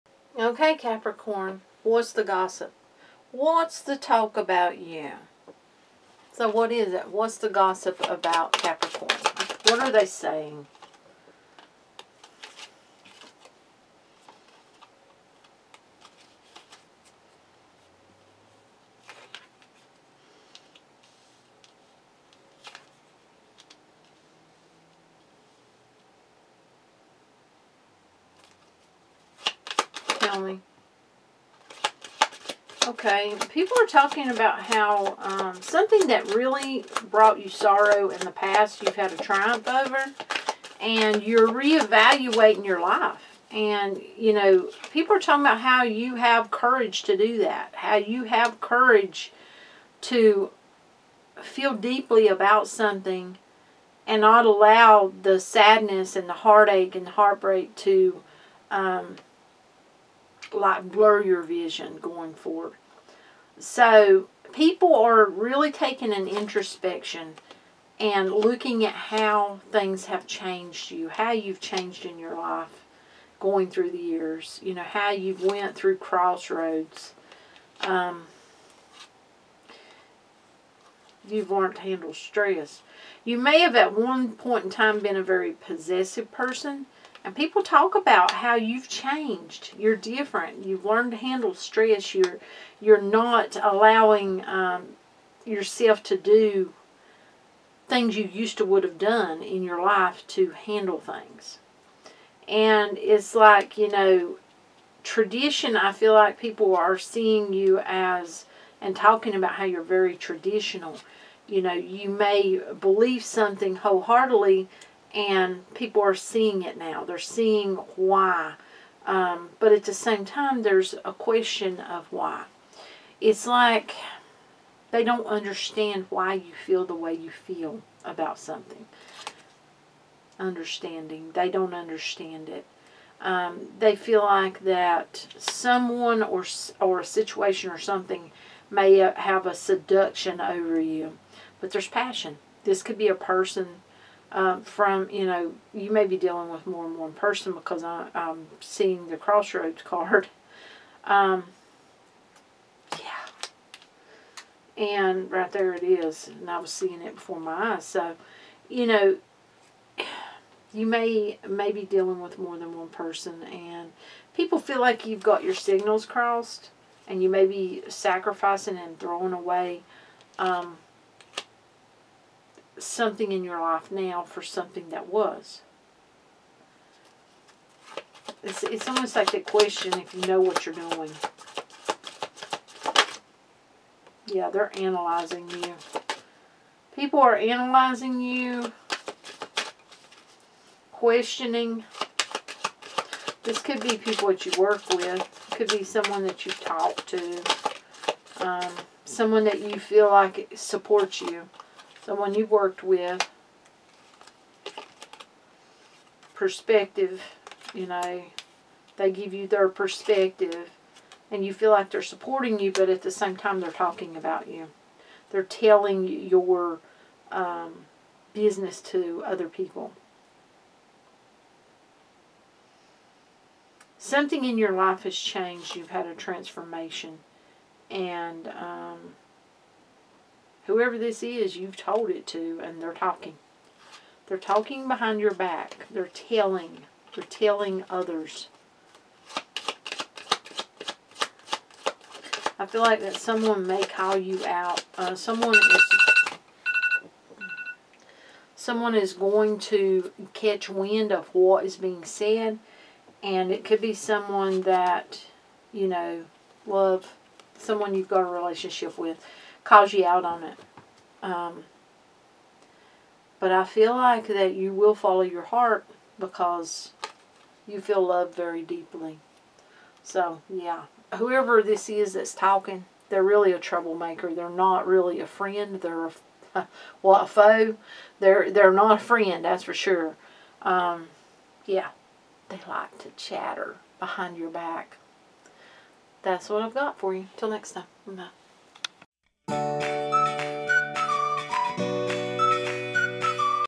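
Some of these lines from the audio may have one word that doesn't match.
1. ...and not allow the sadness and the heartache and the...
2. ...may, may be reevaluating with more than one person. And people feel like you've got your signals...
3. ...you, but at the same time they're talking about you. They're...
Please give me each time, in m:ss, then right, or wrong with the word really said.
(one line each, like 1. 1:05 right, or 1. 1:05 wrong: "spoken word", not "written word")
1. 0:54 right
2. 2:40 wrong: "dealing", not "reevaluating"
3. 3:32 right.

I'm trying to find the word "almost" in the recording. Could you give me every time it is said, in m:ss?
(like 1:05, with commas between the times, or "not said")
2:58.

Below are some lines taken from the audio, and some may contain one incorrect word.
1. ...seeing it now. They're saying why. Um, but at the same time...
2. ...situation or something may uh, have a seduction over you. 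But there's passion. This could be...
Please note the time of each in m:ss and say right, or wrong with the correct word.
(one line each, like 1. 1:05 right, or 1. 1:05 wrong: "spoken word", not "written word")
1. 1:56 wrong: "seeing", not "saying"
2. 2:17 right.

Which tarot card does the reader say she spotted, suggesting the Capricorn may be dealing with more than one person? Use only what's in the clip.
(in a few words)
Crossroads card.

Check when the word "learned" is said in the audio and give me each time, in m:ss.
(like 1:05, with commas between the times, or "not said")
1:21, 1:30.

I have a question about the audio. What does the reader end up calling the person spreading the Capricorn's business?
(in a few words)
A troublemaker.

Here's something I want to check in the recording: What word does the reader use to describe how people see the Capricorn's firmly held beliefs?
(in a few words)
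Traditional.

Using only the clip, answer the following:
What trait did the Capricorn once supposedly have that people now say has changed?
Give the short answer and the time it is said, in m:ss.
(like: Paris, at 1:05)
Possessive, at 1:25.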